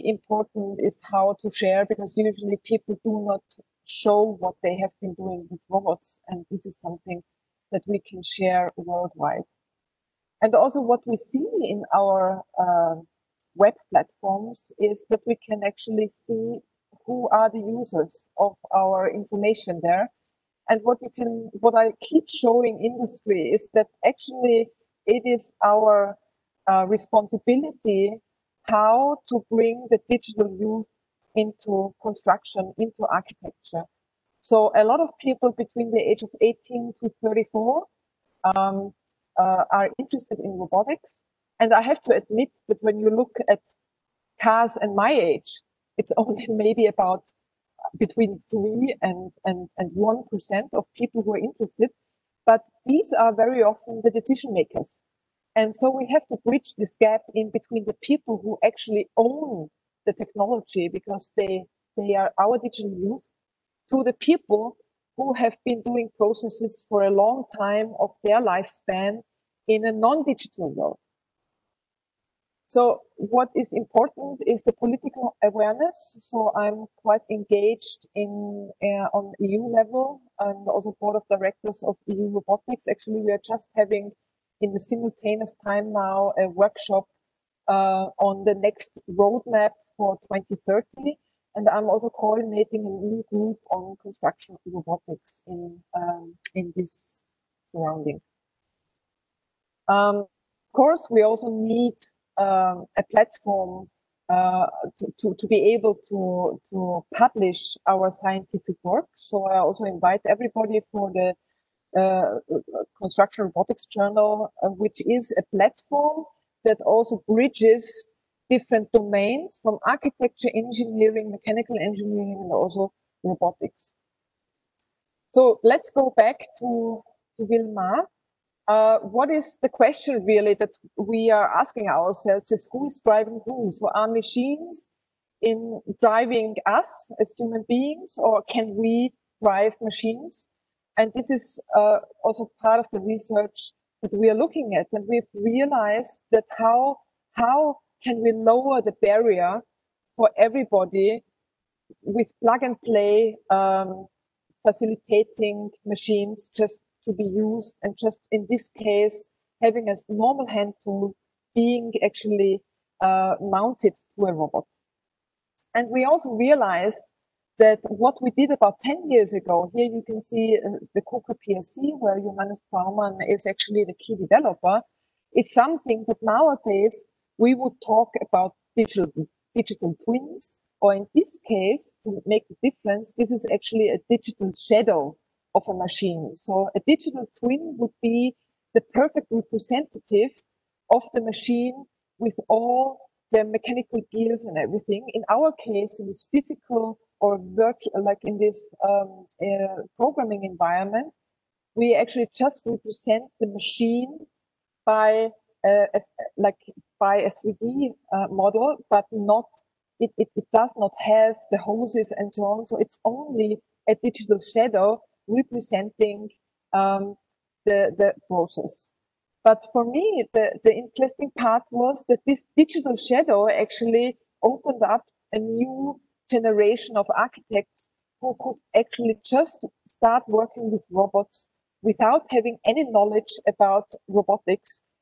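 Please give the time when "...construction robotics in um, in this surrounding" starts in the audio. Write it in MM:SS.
01:34.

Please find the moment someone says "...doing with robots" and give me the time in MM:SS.
00:05.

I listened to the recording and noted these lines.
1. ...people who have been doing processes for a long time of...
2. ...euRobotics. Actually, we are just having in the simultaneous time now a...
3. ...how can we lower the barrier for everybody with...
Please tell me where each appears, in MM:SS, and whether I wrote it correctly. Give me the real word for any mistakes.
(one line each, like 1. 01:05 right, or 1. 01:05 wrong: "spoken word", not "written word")
1. 01:04 right
2. 01:22 right
3. 02:27 right.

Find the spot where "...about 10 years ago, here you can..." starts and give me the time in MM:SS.
02:48.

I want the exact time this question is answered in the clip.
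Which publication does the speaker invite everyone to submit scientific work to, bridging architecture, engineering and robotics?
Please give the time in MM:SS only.
01:52.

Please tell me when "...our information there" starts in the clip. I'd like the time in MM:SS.
00:18.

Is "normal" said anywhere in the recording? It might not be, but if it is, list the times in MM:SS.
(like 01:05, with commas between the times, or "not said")
02:40.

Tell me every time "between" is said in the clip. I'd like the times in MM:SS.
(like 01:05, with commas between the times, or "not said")
00:35, 00:47, 00:57.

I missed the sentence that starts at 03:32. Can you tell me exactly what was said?
So it's only a digital shadow representing um, the, the process.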